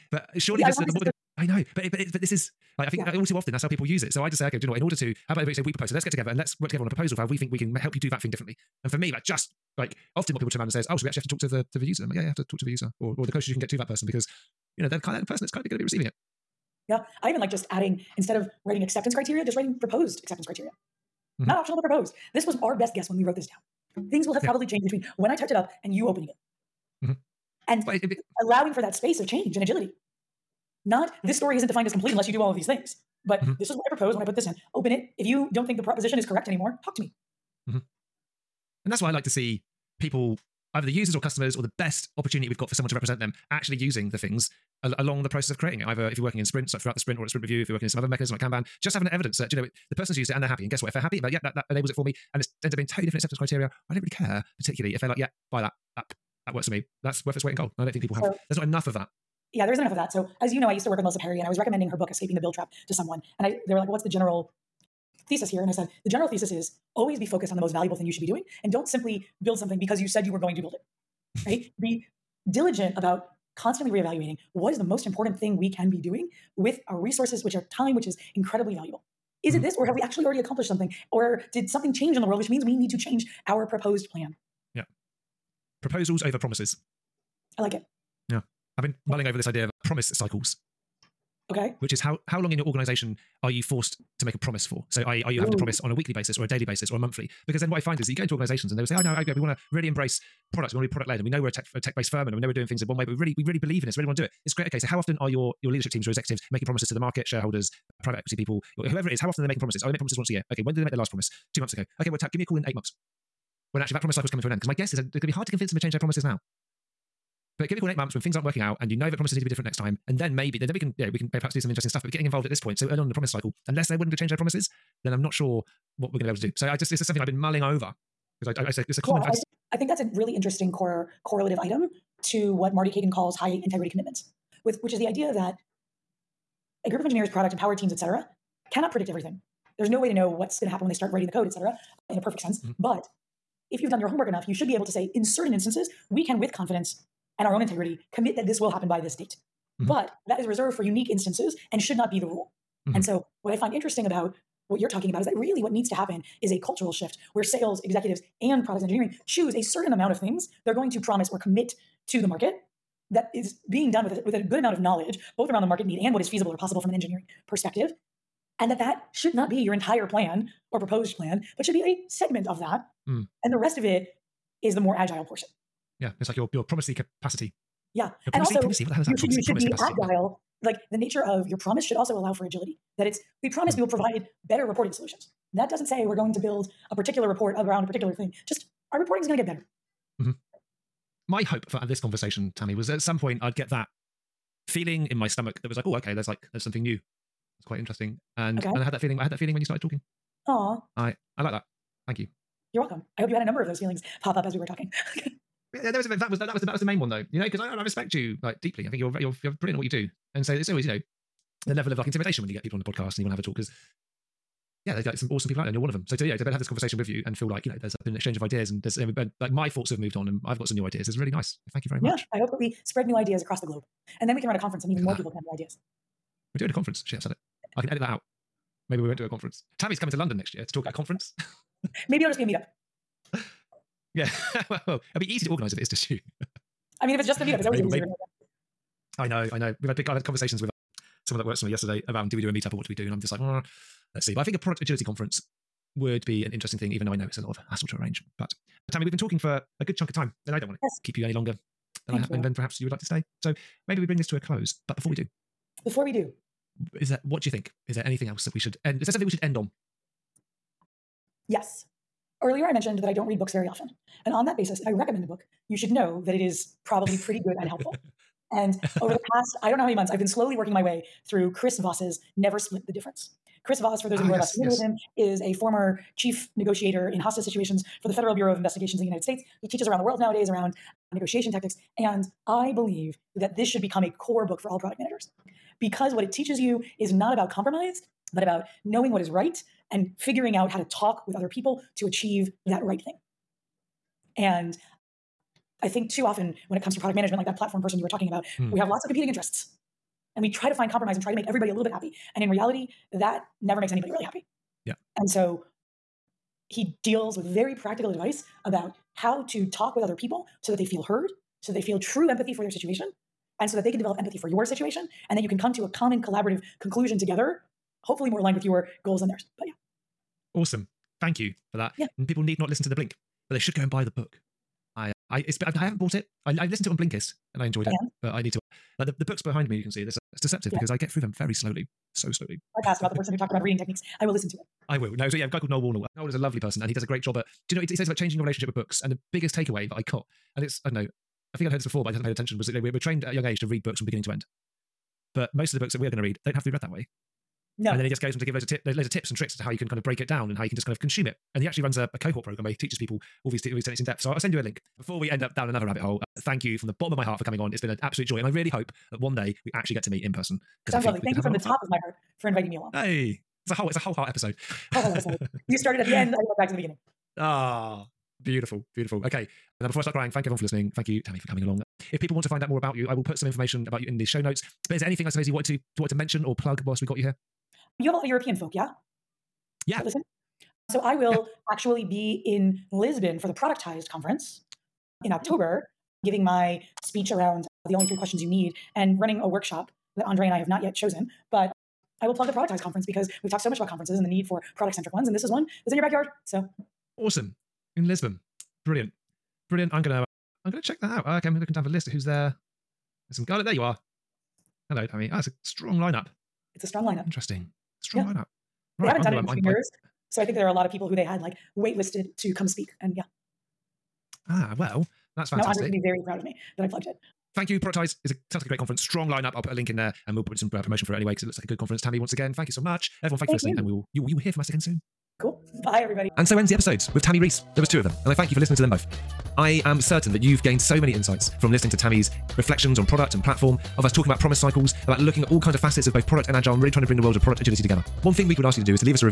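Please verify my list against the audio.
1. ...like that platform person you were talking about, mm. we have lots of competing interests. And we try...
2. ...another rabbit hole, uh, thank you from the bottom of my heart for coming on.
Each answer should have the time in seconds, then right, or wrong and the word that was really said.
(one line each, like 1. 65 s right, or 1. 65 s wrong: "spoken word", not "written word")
1. 297 s right
2. 355 s right.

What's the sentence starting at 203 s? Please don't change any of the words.
I hope you had a number of those feelings pop up as we were talking.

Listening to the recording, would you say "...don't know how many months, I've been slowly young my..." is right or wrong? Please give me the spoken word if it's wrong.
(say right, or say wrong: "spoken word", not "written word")
wrong: "working", not "young".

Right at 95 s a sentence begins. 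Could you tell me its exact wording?
to promise on a weekly basis or a daily basis or a monthly?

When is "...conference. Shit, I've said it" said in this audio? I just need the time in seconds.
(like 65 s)
226 s.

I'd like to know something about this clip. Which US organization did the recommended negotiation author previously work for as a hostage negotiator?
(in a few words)
Federal Bureau of Investigations.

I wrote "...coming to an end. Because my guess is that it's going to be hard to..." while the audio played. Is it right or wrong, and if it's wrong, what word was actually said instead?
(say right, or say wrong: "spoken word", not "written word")
right.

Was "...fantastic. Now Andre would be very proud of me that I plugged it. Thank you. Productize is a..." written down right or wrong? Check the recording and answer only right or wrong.
right.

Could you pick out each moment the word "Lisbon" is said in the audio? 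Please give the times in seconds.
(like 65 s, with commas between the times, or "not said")
382 s, 398 s.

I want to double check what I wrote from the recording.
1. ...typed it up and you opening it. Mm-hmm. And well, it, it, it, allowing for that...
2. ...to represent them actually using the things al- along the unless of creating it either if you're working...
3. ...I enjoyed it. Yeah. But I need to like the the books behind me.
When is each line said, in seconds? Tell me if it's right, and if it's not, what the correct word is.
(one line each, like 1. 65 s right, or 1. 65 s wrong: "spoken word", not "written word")
1. 25 s right
2. 42 s wrong: "process", not "unless"
3. 327 s right.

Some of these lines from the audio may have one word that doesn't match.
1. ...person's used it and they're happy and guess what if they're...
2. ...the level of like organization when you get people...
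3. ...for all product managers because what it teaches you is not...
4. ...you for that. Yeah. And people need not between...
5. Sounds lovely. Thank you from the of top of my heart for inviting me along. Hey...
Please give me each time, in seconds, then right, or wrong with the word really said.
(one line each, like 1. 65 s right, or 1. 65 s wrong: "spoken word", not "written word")
1. 49 s right
2. 211 s wrong: "intimidation", not "organization"
3. 284 s right
4. 321 s wrong: "listen", not "between"
5. 360 s right.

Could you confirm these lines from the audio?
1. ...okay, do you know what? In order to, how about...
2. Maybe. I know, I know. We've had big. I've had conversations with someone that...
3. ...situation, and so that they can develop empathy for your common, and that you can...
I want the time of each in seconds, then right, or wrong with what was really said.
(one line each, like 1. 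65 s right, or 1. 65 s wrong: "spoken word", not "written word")
1. 4 s right
2. 238 s right
3. 312 s wrong: "situation", not "common".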